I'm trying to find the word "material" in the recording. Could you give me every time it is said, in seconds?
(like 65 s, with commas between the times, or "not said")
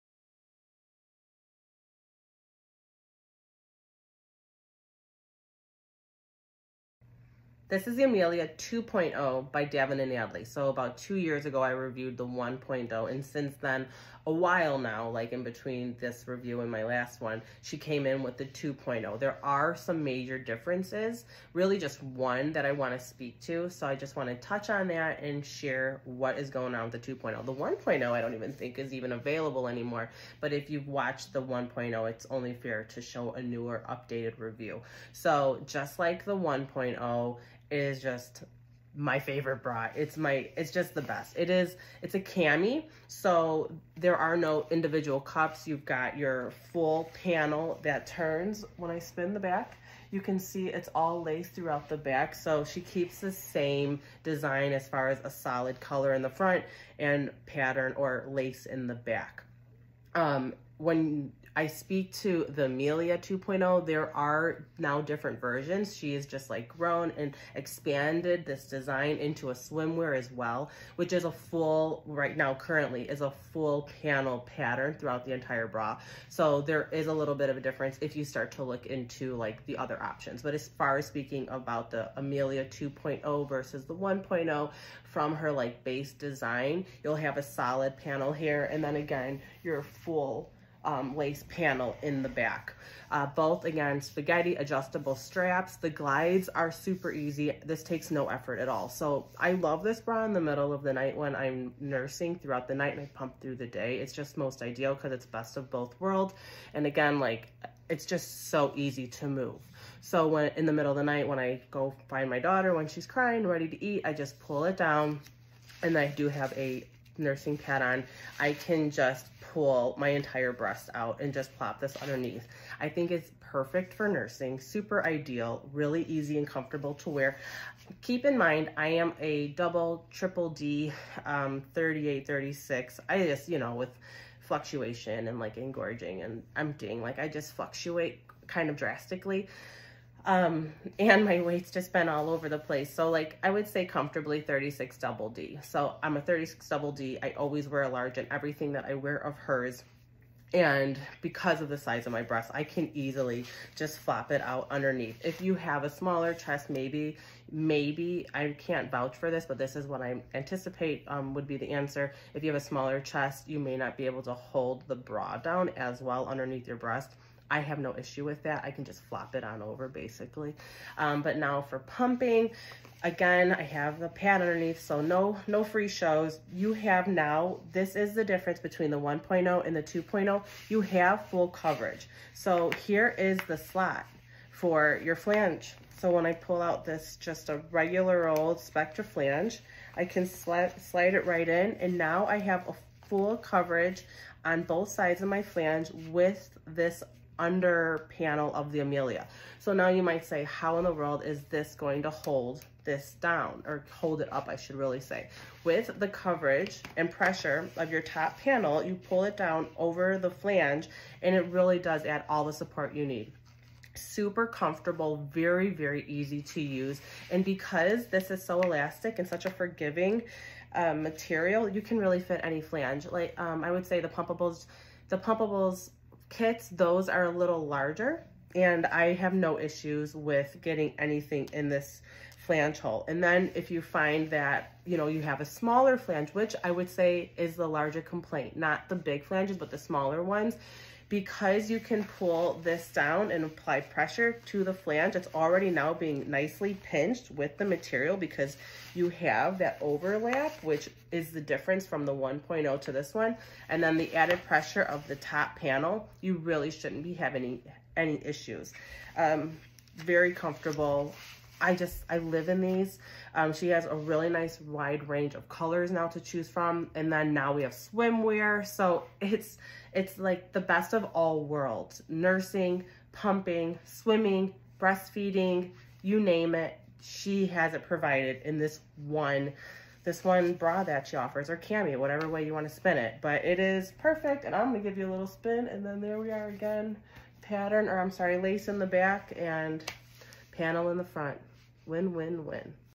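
220 s, 247 s.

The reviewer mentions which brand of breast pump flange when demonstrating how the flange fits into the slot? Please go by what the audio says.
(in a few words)
Spectra.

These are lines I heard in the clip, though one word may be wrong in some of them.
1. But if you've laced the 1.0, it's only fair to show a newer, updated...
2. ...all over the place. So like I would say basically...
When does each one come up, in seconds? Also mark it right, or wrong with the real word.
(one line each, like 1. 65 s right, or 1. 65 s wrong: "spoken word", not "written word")
1. 30 s wrong: "watched", not "laced"
2. 142 s wrong: "comfortably", not "basically".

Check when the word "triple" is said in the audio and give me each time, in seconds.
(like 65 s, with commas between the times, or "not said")
130 s.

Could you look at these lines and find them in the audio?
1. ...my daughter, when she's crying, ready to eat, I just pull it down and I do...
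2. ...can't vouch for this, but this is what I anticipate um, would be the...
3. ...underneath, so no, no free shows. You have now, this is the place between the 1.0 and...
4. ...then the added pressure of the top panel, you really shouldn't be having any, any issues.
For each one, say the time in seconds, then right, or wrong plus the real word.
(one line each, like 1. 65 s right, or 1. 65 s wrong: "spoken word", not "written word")
1. 112 s right
2. 158 s right
3. 174 s wrong: "difference", not "place"
4. 253 s right.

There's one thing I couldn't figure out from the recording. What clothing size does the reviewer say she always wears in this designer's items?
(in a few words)
large.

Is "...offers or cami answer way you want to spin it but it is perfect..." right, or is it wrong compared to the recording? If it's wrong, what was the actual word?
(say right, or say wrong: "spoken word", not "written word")
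wrong: "whatever", not "answer".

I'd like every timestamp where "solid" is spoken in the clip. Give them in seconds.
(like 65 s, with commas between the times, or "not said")
55 s, 87 s.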